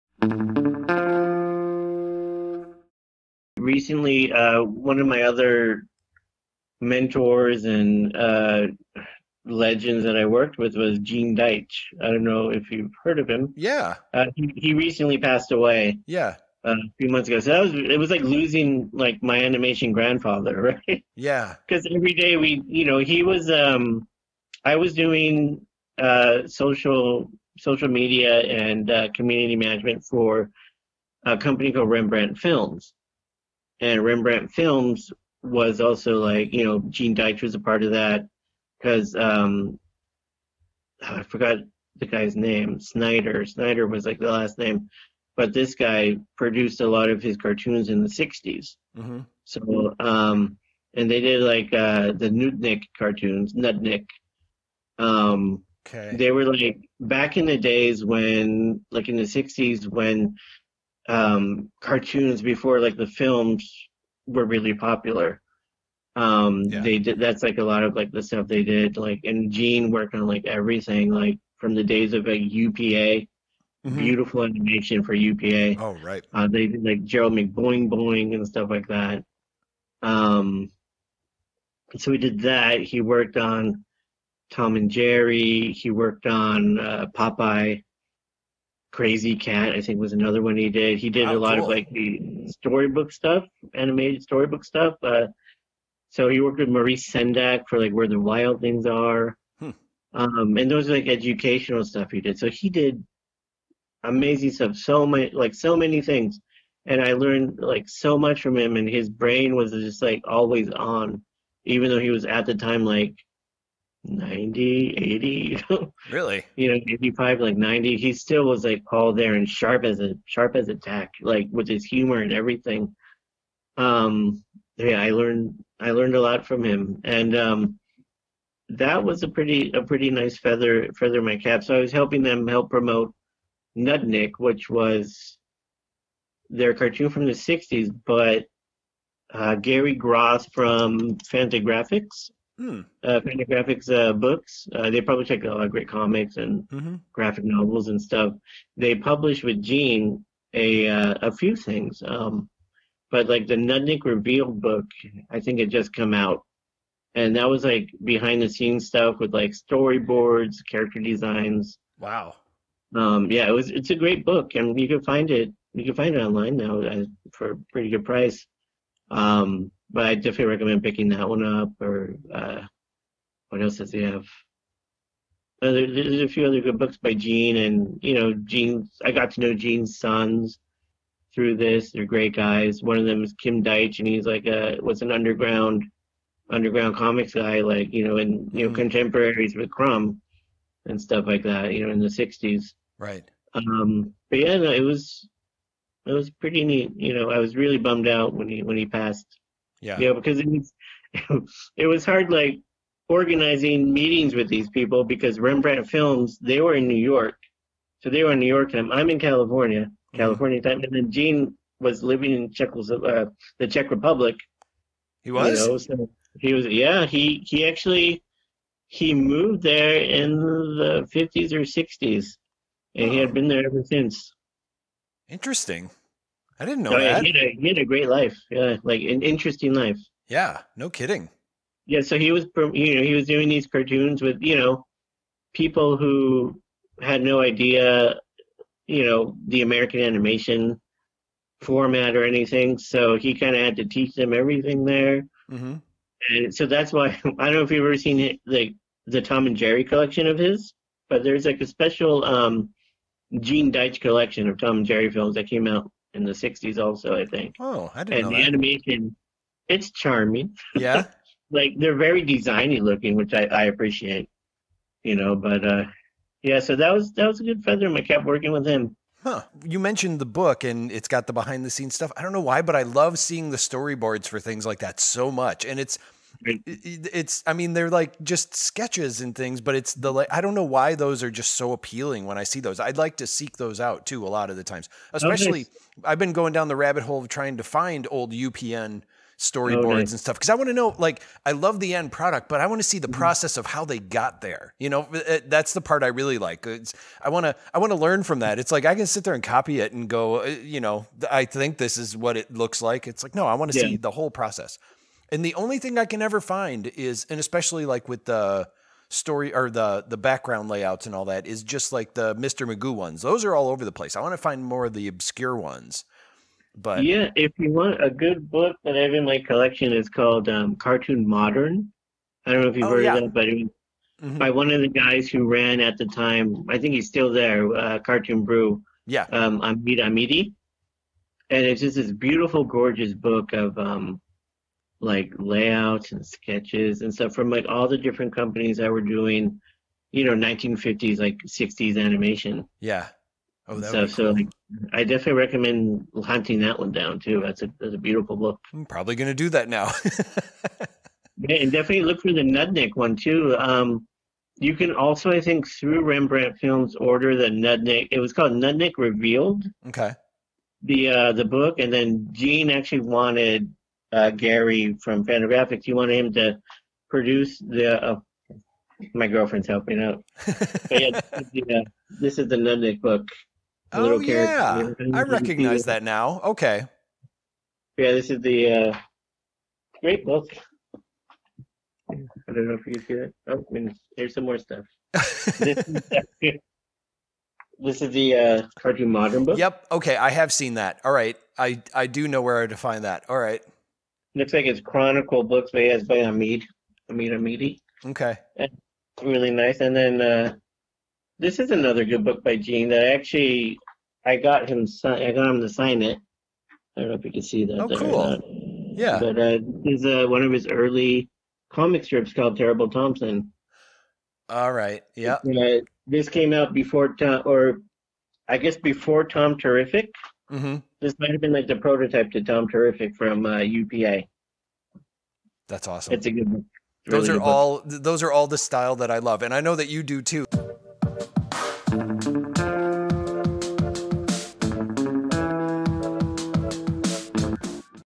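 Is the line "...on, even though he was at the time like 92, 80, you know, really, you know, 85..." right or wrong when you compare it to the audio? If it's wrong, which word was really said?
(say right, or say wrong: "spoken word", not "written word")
wrong: "90", not "92".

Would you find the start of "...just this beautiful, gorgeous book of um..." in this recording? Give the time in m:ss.
5:31.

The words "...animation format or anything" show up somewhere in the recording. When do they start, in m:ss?
4:00.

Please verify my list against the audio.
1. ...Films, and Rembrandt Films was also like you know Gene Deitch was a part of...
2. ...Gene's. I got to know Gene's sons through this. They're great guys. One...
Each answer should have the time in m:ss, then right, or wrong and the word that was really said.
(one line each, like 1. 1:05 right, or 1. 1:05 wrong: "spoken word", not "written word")
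1. 0:32 right
2. 2:58 right.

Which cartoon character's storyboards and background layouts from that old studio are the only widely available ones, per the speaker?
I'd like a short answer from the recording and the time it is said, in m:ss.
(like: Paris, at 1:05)
Mr. Magoo, at 5:12.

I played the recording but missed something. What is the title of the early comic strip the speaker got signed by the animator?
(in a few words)
Terrible Thompson.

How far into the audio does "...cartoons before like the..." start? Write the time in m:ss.
1:01.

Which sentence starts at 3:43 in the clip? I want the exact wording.
he had been there ever since interesting I didn't know no, that.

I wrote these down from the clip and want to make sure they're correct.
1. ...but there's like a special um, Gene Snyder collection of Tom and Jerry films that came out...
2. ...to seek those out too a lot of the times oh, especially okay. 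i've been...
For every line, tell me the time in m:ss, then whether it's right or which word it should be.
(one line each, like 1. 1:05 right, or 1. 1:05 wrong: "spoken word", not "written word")
1. 4:11 wrong: "Deitch", not "Snyder"
2. 4:43 right.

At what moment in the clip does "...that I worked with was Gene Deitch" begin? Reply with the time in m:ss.
0:10.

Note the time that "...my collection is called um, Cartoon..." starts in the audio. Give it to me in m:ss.
5:19.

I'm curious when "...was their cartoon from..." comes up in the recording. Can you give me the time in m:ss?
2:14.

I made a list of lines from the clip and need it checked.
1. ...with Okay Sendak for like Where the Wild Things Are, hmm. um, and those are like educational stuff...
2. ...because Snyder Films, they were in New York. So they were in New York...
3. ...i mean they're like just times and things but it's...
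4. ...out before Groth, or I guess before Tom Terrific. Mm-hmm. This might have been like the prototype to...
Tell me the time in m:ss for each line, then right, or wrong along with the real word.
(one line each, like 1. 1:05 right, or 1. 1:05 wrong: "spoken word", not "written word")
1. 1:36 wrong: "Maurice", not "Okay"
2. 3:25 wrong: "Rembrandt", not "Snyder"
3. 4:37 wrong: "sketches", not "times"
4. 6:56 wrong: "Tom", not "Groth".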